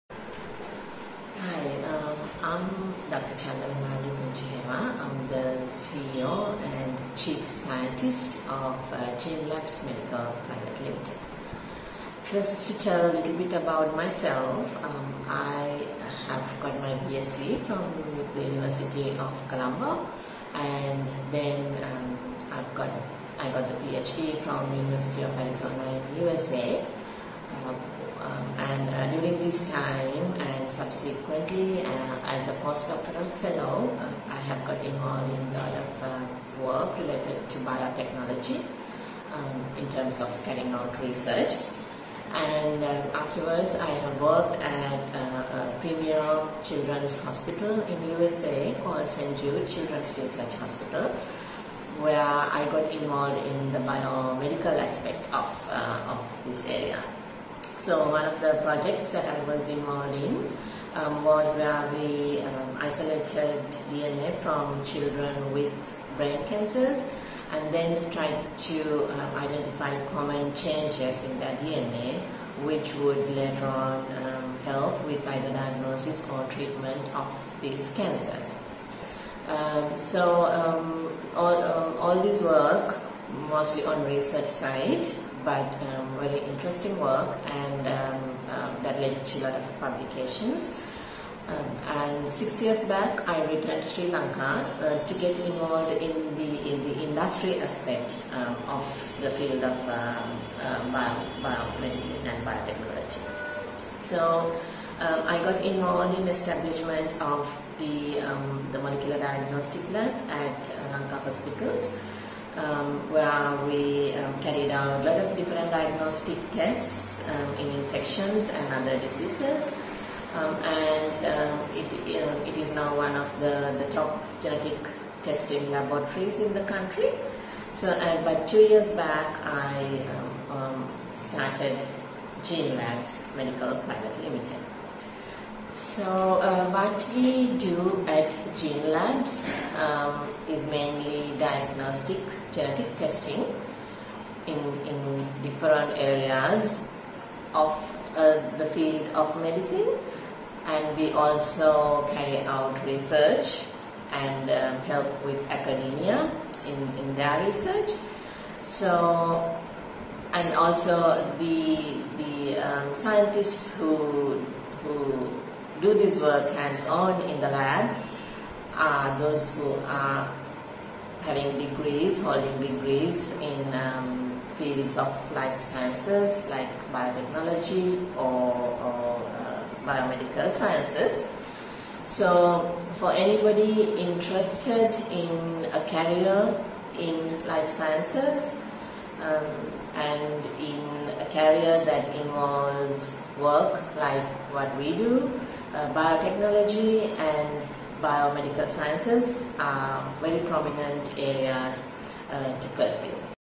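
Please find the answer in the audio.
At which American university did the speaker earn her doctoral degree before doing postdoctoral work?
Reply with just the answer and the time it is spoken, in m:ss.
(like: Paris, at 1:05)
University of Arizona, at 0:24.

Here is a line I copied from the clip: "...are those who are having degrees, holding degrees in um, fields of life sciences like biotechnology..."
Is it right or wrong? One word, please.
right.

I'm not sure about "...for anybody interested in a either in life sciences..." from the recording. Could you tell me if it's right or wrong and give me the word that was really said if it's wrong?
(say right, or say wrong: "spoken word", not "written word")
wrong: "career", not "either".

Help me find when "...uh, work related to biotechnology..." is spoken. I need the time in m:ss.
0:36.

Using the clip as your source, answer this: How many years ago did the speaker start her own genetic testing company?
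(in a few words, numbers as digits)
2.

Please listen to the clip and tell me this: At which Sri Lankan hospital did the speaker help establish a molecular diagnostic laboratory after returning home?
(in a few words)
Lanka Hospitals.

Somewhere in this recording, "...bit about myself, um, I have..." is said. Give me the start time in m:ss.
0:13.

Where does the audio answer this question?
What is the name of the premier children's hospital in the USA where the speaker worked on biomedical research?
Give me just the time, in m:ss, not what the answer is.
0:49.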